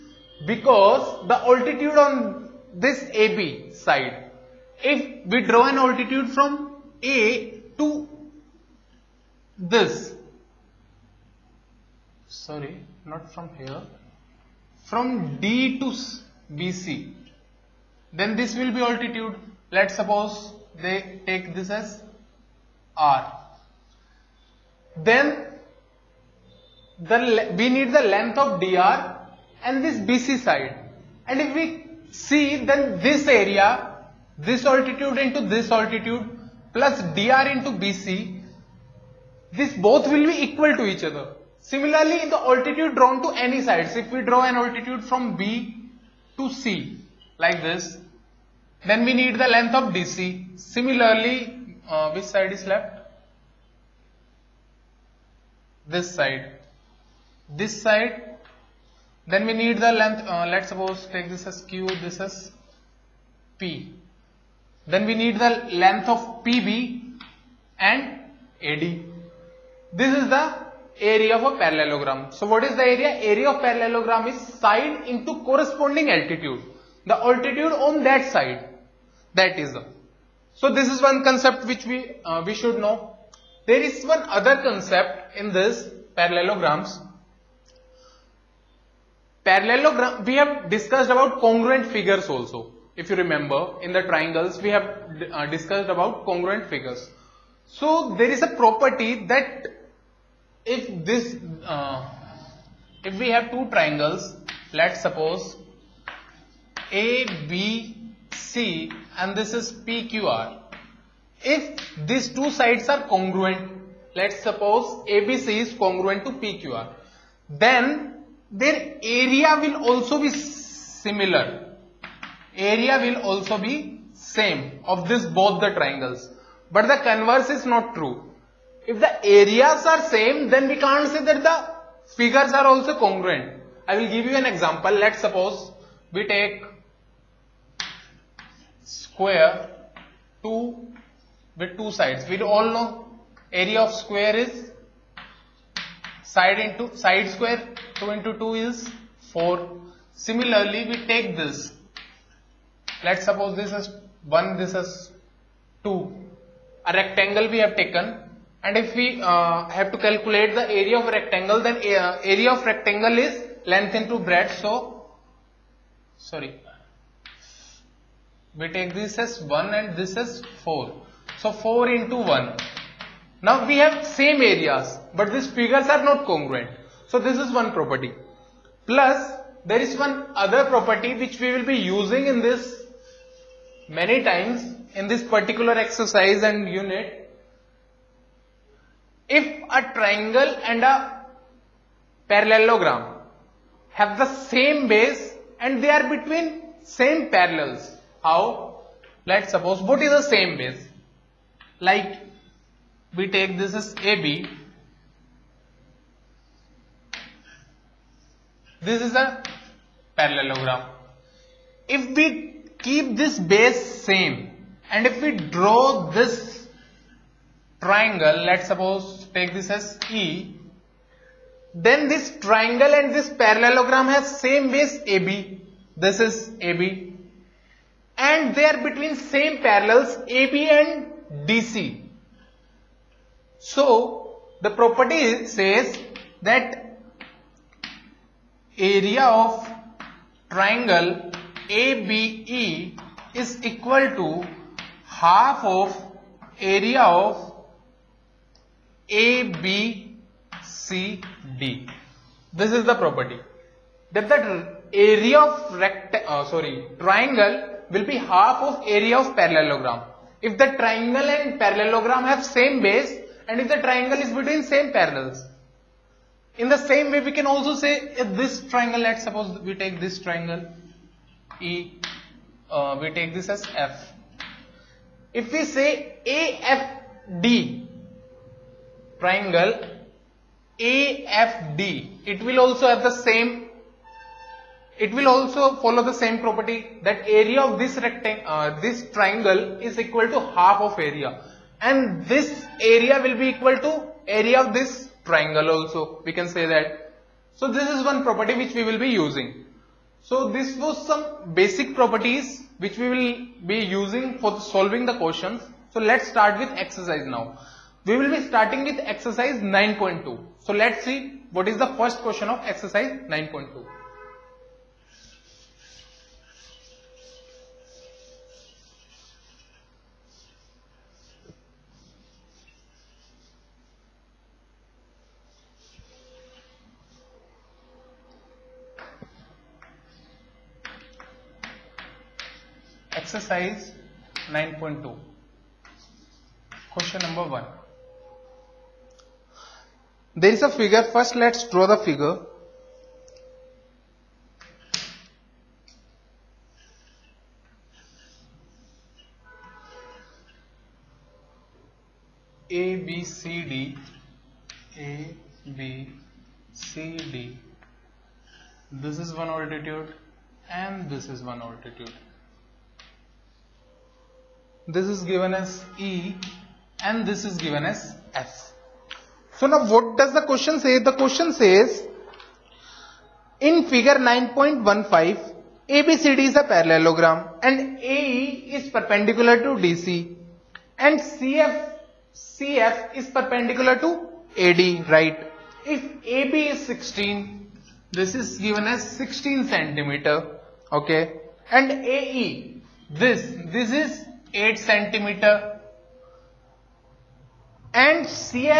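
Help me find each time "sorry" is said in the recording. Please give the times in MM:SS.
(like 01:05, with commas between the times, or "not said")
00:12, 02:46, 04:16.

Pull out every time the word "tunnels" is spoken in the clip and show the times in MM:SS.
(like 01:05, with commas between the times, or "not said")
not said.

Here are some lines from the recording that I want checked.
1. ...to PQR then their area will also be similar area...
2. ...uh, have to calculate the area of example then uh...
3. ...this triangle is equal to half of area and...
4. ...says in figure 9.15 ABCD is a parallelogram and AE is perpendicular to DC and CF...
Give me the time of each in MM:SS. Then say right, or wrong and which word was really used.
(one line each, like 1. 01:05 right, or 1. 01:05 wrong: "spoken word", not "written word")
1. 01:56 right
2. 02:39 wrong: "rectangle", not "example"
3. 04:48 right
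4. 06:11 right.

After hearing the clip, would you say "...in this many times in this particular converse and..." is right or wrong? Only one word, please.
wrong.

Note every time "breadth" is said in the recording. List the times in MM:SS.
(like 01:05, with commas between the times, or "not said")
02:44.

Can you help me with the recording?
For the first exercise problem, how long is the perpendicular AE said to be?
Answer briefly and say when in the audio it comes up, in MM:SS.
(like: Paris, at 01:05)
8 centimeter, at 06:34.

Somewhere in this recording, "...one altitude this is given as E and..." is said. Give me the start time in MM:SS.
06:01.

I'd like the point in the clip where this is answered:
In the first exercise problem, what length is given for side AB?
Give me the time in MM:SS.
06:29.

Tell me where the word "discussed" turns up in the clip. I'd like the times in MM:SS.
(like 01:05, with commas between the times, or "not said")
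01:30, 01:35.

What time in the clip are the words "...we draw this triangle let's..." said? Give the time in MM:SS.
03:35.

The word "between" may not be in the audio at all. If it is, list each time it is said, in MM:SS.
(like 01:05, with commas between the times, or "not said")
03:16, 03:48, 04:24.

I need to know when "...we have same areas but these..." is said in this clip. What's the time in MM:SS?
02:53.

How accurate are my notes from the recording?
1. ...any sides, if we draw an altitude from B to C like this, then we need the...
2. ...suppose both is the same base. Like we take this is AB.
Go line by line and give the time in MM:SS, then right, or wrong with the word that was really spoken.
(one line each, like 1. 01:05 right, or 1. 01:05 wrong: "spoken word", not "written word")
1. 00:43 right
2. 03:19 right.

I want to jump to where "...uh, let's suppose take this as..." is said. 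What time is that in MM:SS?
01:00.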